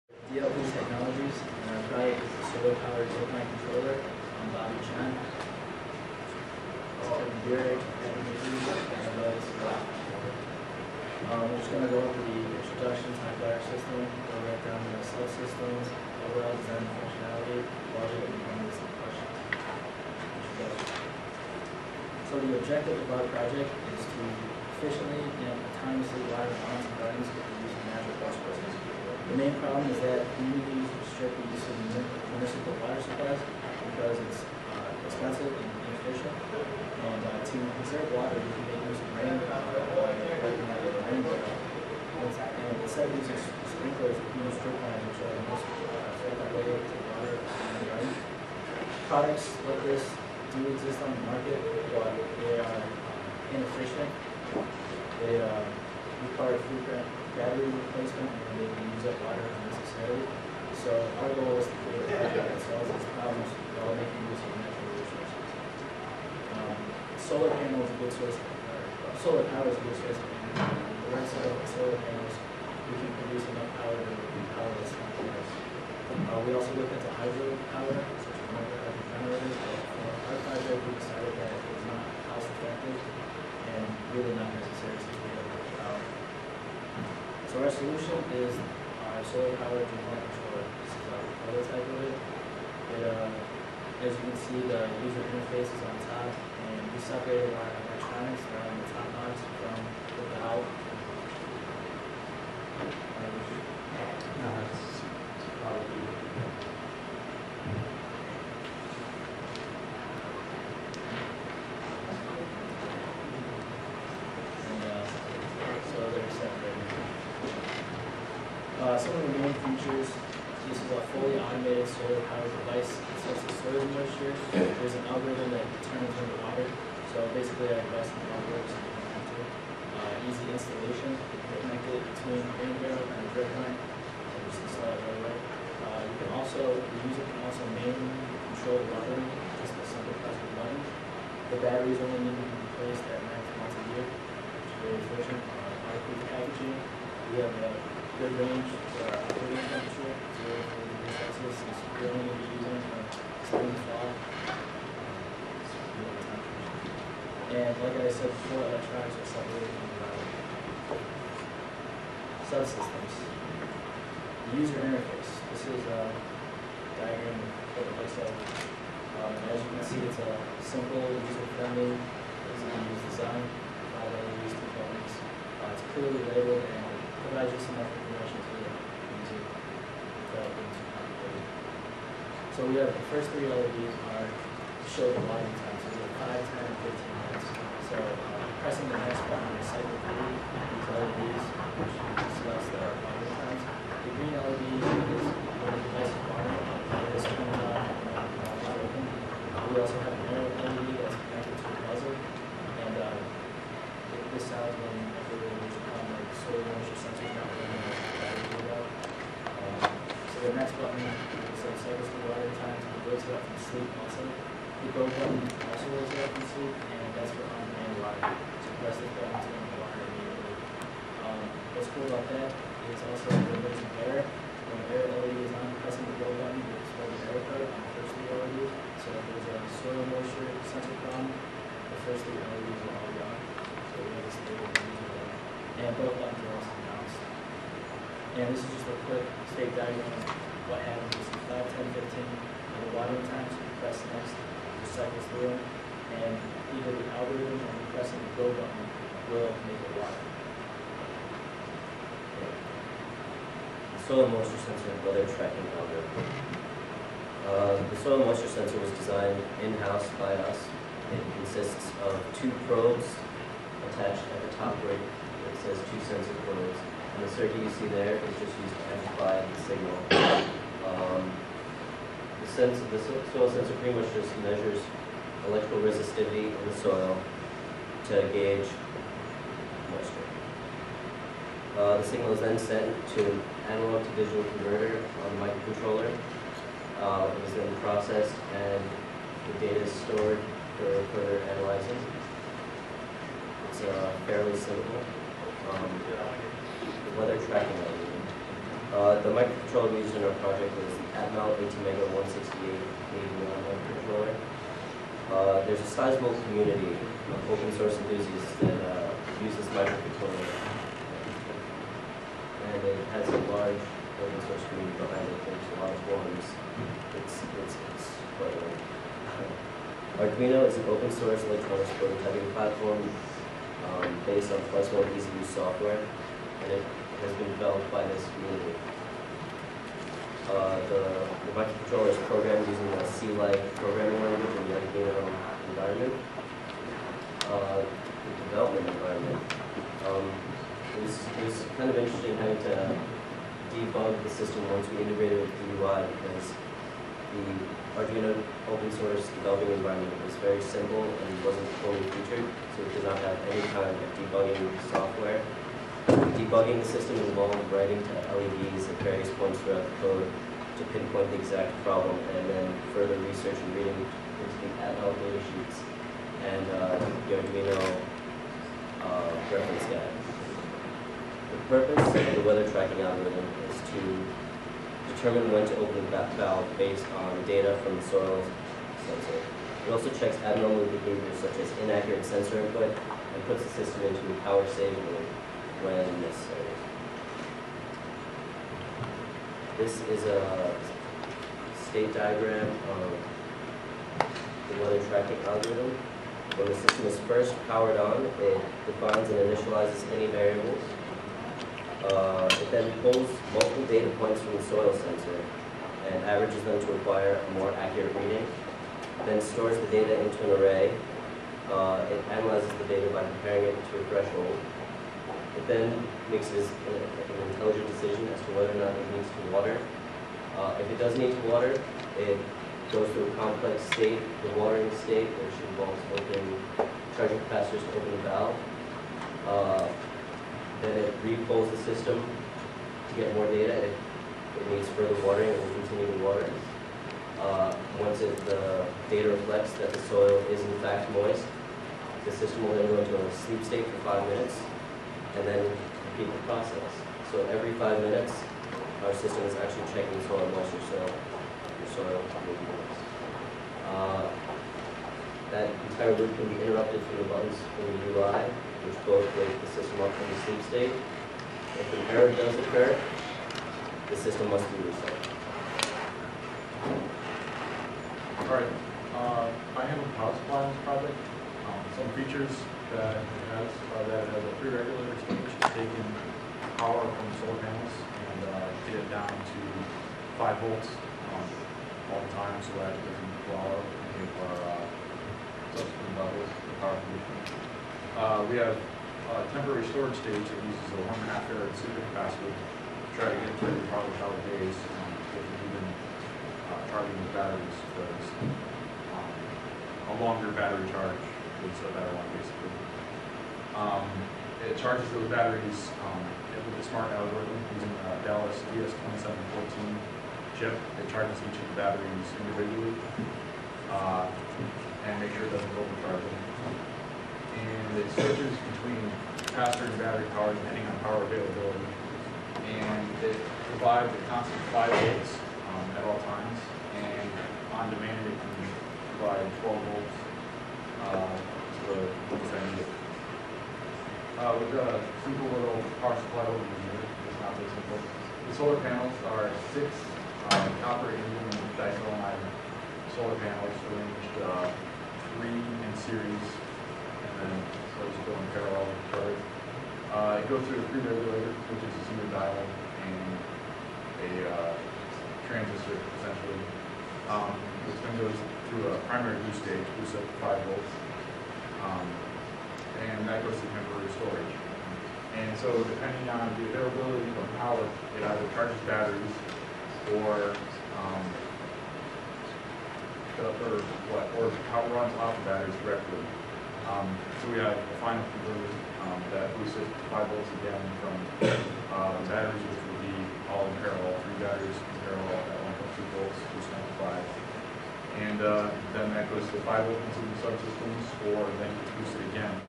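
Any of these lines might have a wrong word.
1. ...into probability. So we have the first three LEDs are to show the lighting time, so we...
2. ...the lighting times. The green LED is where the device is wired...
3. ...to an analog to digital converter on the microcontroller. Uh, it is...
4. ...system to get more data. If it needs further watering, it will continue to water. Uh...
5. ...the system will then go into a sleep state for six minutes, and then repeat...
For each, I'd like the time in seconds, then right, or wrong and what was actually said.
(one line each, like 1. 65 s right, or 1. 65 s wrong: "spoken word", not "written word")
1. 180 s right
2. 192 s right
3. 283 s right
4. 431 s right
5. 442 s wrong: "five", not "six".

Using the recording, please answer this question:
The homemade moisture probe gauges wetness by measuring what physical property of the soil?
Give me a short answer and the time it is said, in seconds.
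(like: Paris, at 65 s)
electrical resistivity, at 275 s.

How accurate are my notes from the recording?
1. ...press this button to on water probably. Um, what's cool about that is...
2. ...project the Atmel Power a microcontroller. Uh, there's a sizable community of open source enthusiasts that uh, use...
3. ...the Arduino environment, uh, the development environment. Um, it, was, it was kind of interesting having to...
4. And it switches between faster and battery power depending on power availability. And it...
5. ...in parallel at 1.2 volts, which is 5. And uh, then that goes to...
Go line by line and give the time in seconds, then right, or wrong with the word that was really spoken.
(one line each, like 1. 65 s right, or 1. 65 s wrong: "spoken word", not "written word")
1. 218 s wrong: "immediately", not "probably"
2. 300 s wrong: "ATmega", not "Power"
3. 334 s right
4. 517 s right
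5. 584 s right.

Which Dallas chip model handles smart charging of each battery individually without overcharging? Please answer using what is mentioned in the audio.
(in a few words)
DS2714.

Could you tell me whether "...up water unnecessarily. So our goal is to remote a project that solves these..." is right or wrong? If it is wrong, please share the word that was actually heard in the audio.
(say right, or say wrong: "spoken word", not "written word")
wrong: "create", not "remote".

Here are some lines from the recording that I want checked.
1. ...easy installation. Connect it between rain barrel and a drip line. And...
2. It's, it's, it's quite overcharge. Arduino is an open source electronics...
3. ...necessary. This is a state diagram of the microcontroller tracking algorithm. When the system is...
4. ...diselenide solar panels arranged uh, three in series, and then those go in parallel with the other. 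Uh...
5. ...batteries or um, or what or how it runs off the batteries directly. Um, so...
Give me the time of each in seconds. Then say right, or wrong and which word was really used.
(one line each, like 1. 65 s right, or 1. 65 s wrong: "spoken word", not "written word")
1. 130 s right
2. 317 s wrong: "large", not "overcharge"
3. 386 s wrong: "weather", not "microcontroller"
4. 541 s right
5. 568 s right.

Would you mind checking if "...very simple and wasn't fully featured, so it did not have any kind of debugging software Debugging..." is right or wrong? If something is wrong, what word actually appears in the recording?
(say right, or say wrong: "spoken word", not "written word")
right.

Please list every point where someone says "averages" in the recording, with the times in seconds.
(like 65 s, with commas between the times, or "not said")
406 s.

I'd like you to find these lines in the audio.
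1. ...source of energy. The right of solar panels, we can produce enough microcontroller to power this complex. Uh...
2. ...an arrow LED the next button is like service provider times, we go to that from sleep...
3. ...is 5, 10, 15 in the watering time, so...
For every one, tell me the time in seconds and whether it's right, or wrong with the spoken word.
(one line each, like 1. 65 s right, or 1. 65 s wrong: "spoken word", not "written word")
1. 69 s wrong: "power", not "microcontroller"
2. 200 s right
3. 241 s right.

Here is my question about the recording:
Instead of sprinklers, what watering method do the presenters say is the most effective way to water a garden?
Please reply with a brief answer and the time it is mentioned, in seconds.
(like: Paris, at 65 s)
drip lines, at 44 s.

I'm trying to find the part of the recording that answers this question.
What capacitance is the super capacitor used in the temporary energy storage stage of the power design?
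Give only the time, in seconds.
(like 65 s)
491 s.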